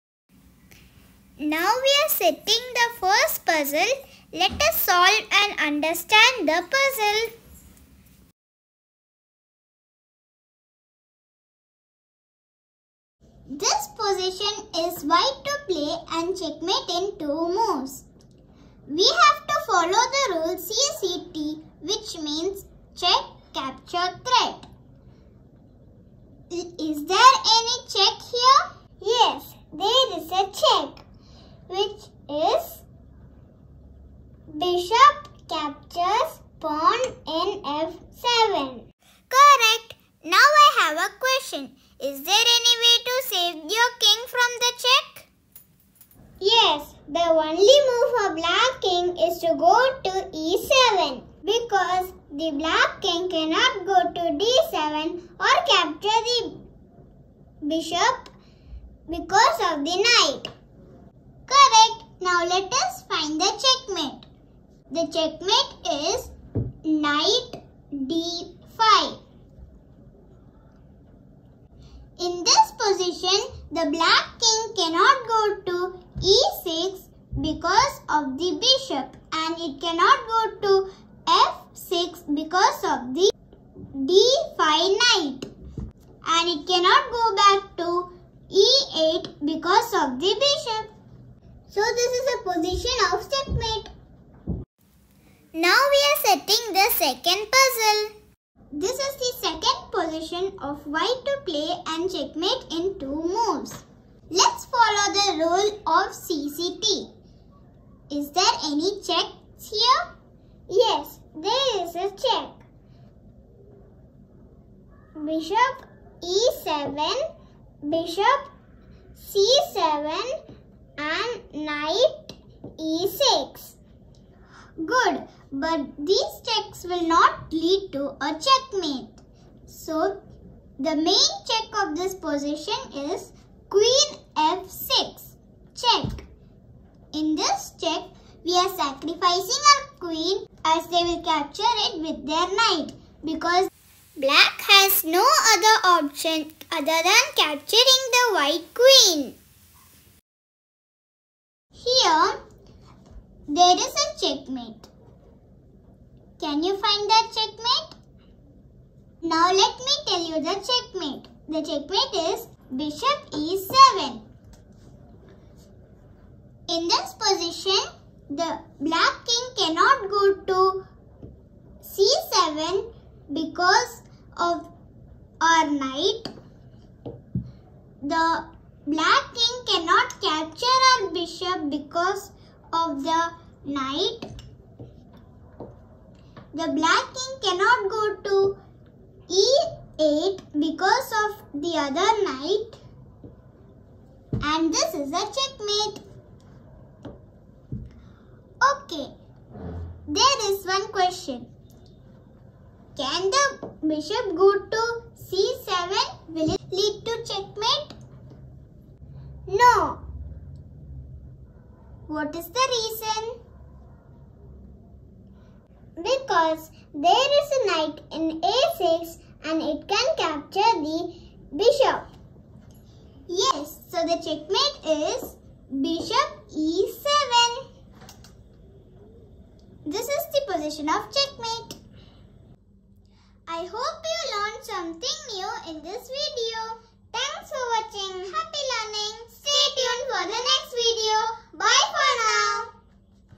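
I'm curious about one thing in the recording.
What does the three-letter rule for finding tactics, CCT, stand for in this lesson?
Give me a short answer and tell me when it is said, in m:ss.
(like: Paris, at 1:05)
check, capture, threat, at 0:22.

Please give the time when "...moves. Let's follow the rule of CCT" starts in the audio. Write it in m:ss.
1:43.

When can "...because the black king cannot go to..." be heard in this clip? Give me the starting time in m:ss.
0:51.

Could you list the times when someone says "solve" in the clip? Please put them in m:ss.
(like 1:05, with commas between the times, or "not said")
0:04.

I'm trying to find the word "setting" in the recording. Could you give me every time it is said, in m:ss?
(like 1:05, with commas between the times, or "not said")
0:02, 1:36.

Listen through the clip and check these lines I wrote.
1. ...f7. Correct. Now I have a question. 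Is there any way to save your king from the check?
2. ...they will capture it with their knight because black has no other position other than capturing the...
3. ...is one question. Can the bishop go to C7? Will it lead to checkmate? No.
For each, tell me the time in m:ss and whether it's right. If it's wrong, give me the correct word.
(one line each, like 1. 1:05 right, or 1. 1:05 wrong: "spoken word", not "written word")
1. 0:37 right
2. 2:20 wrong: "option", not "position"
3. 3:20 right.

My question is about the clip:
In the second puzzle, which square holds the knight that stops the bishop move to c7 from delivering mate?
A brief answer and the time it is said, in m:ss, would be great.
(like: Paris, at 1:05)
a6, at 3:38.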